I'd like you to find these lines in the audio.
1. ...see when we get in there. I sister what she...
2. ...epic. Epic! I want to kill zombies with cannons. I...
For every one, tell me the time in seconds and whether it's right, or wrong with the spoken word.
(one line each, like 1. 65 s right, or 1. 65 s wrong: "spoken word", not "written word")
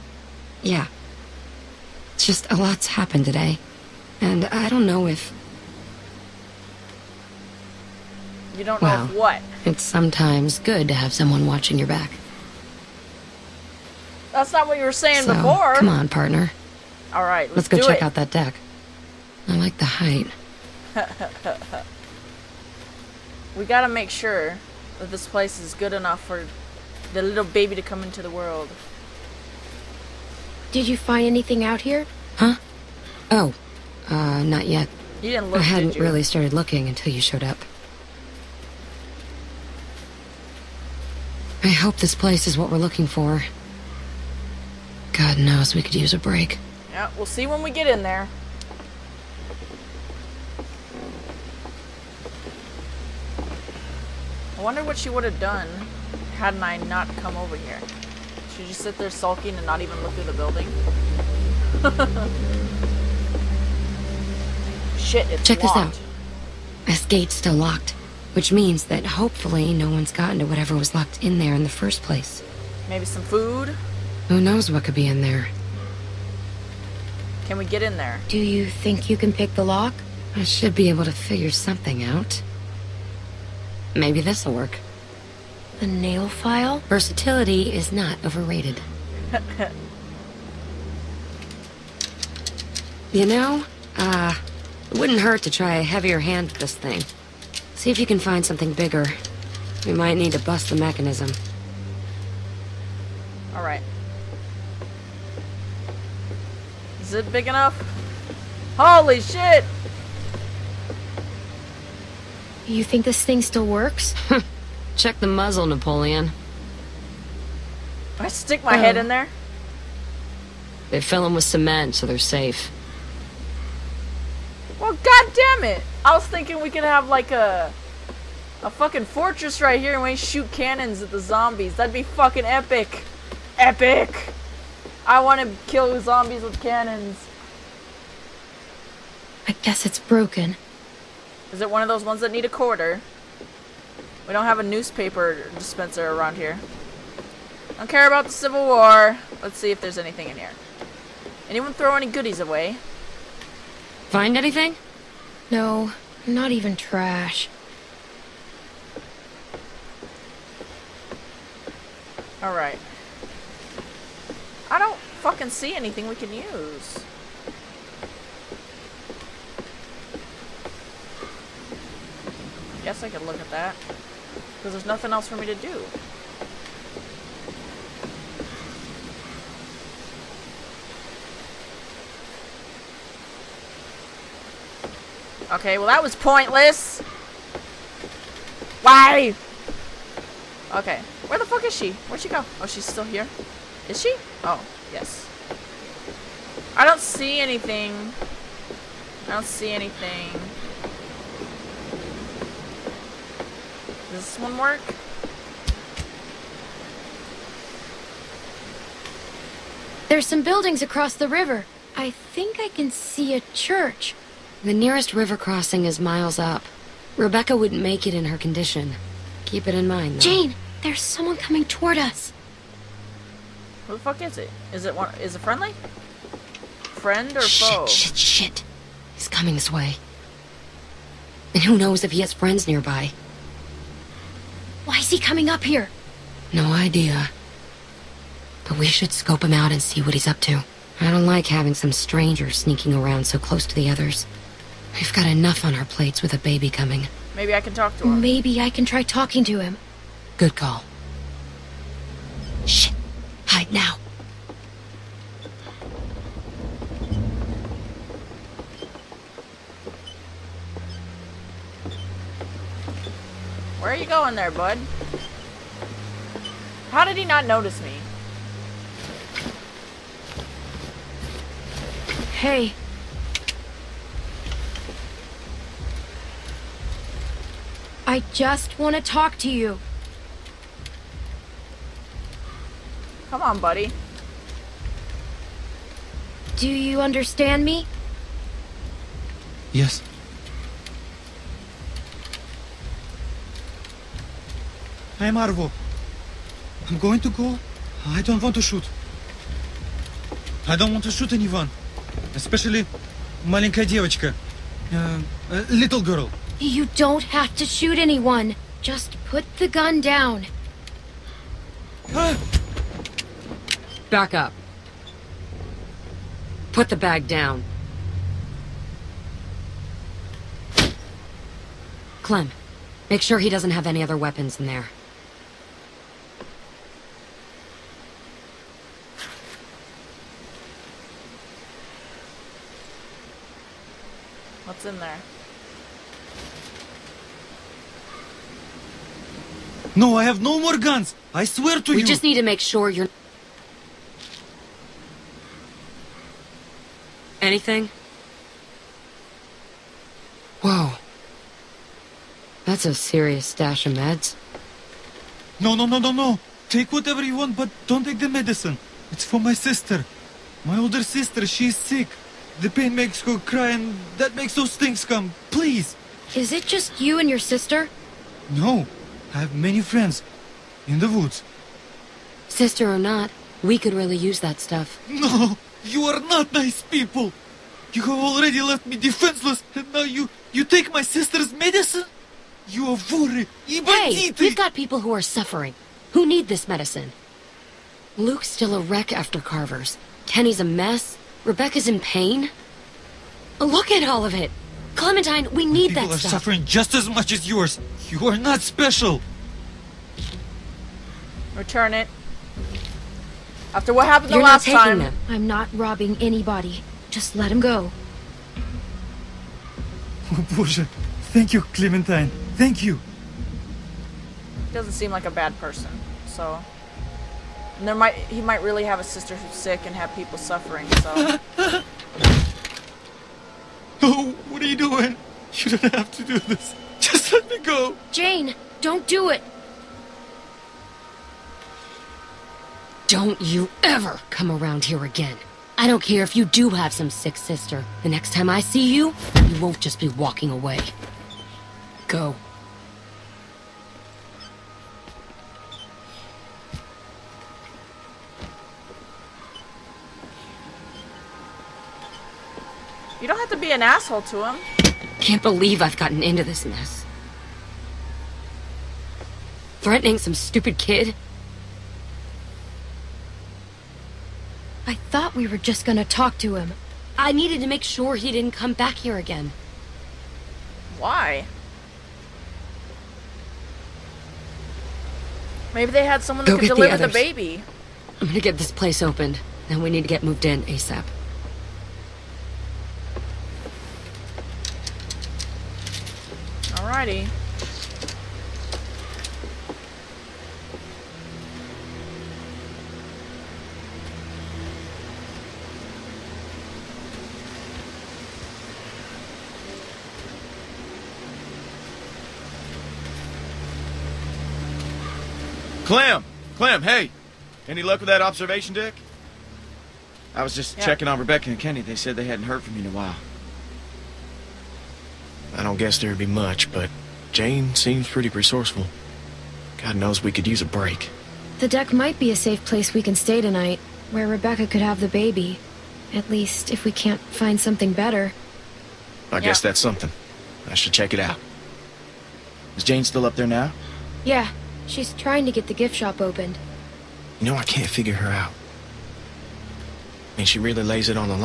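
1. 47 s wrong: "wonder", not "sister"
2. 132 s right.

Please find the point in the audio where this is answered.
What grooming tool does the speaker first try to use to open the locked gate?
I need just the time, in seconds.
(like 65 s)
85 s.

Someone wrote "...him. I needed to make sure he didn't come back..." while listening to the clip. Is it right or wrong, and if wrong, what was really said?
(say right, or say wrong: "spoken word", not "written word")
right.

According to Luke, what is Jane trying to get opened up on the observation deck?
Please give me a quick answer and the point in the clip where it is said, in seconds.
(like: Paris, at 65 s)
The gift shop, at 535 s.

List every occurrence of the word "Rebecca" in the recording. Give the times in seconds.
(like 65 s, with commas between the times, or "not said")
217 s, 391 s, 511 s, 524 s.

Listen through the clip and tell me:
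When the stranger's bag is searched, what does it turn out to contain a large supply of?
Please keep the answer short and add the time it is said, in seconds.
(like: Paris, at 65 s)
Meds, at 353 s.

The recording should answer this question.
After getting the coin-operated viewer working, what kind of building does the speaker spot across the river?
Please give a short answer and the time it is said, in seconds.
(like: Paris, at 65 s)
A church, at 213 s.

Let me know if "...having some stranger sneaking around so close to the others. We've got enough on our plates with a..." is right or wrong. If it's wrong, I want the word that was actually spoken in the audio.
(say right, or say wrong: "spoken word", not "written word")
right.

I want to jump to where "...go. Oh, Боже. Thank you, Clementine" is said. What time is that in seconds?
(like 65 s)
407 s.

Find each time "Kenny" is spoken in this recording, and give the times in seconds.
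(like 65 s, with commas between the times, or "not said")
390 s, 511 s.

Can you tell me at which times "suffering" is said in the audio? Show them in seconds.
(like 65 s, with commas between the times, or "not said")
385 s, 396 s, 420 s.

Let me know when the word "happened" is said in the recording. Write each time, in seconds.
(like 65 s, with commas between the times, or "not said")
2 s, 404 s.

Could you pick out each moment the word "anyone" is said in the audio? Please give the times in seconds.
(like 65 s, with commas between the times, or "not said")
151 s, 301 s, 308 s.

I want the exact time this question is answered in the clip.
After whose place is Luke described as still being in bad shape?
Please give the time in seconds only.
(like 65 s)
389 s.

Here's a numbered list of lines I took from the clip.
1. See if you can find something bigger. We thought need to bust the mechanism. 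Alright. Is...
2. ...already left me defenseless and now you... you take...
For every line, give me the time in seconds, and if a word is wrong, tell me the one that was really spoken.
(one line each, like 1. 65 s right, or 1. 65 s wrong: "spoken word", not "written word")
1. 97 s wrong: "might", not "thought"
2. 378 s right.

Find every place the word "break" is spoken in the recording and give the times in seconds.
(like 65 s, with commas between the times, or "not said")
46 s, 520 s.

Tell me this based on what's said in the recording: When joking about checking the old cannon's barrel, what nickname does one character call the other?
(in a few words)
Napoleon.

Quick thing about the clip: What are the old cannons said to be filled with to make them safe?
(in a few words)
Cement.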